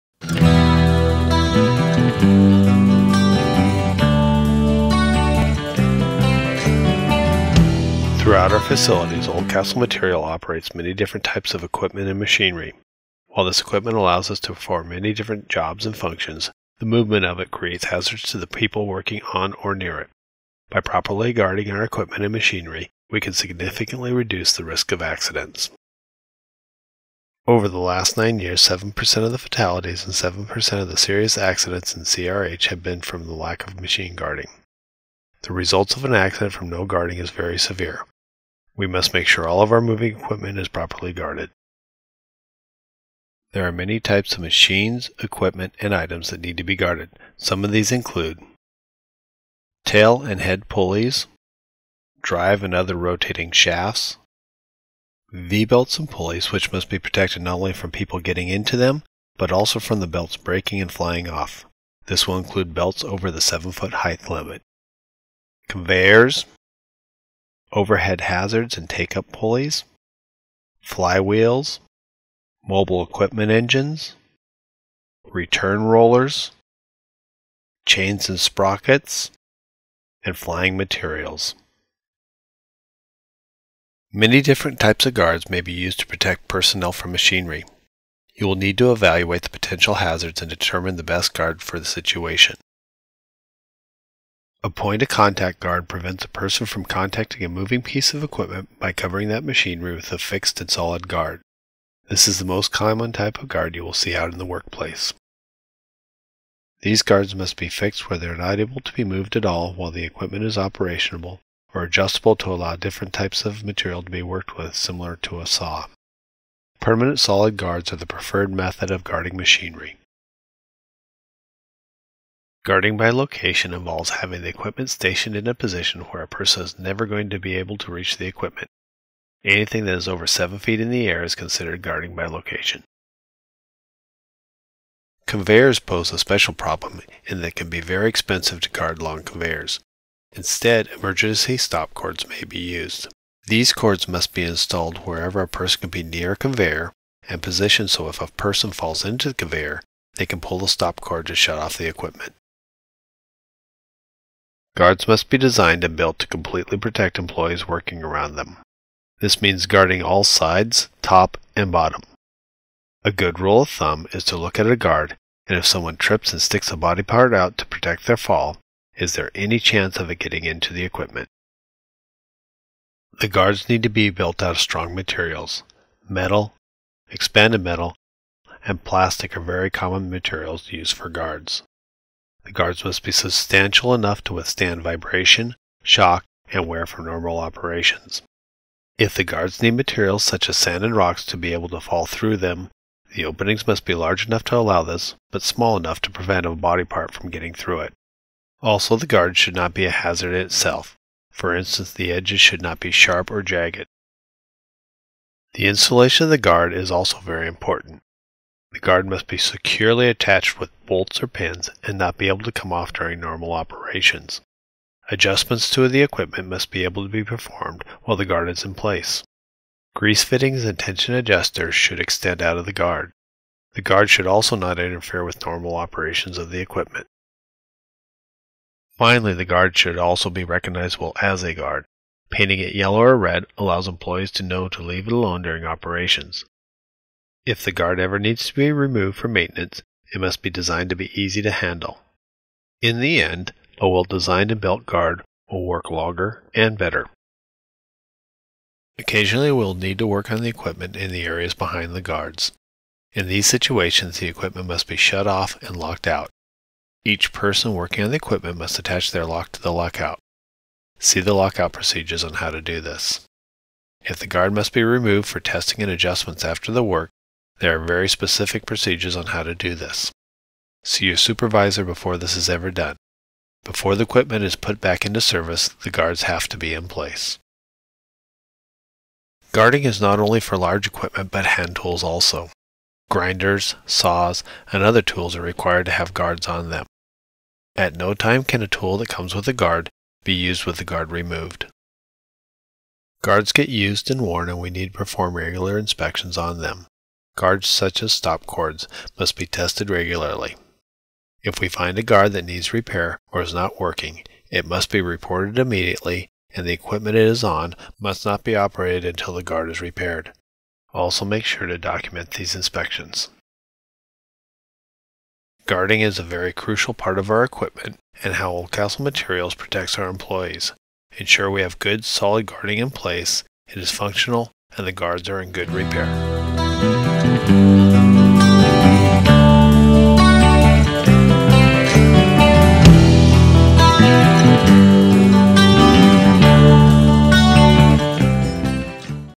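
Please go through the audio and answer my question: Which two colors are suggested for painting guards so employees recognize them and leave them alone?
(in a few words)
Yellow or red.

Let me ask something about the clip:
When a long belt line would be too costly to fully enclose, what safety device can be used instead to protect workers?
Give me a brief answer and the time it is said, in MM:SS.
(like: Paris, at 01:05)
Emergency stop cords, at 02:20.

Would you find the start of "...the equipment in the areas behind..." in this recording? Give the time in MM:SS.
04:10.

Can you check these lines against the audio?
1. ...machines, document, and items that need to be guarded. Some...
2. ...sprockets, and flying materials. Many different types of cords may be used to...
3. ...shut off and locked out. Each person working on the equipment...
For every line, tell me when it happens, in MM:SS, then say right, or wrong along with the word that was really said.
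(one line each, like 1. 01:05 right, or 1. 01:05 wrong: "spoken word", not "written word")
1. 00:44 wrong: "equipment", not "document"
2. 01:18 wrong: "guards", not "cords"
3. 04:14 right.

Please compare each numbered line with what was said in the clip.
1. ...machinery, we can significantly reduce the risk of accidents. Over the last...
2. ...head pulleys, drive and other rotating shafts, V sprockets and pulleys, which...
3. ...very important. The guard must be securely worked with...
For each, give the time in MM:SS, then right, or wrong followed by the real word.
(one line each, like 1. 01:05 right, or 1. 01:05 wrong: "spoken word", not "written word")
1. 00:22 right
2. 00:50 wrong: "belts", not "sprockets"
3. 03:27 wrong: "attached", not "worked".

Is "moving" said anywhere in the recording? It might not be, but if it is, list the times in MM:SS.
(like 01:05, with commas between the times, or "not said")
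00:39, 01:37.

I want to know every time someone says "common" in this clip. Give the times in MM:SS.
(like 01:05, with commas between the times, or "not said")
01:42, 02:59.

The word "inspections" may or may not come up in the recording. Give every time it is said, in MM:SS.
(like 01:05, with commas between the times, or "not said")
04:55, 05:12.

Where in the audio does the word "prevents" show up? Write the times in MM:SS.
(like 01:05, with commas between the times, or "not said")
01:35, 03:16.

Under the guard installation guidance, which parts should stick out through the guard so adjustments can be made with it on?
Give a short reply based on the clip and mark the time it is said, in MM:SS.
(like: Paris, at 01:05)
Grease fittings and tension adjusters, at 03:39.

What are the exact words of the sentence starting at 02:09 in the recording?
Anything that is over 7 feet in the air is considered guarding by location.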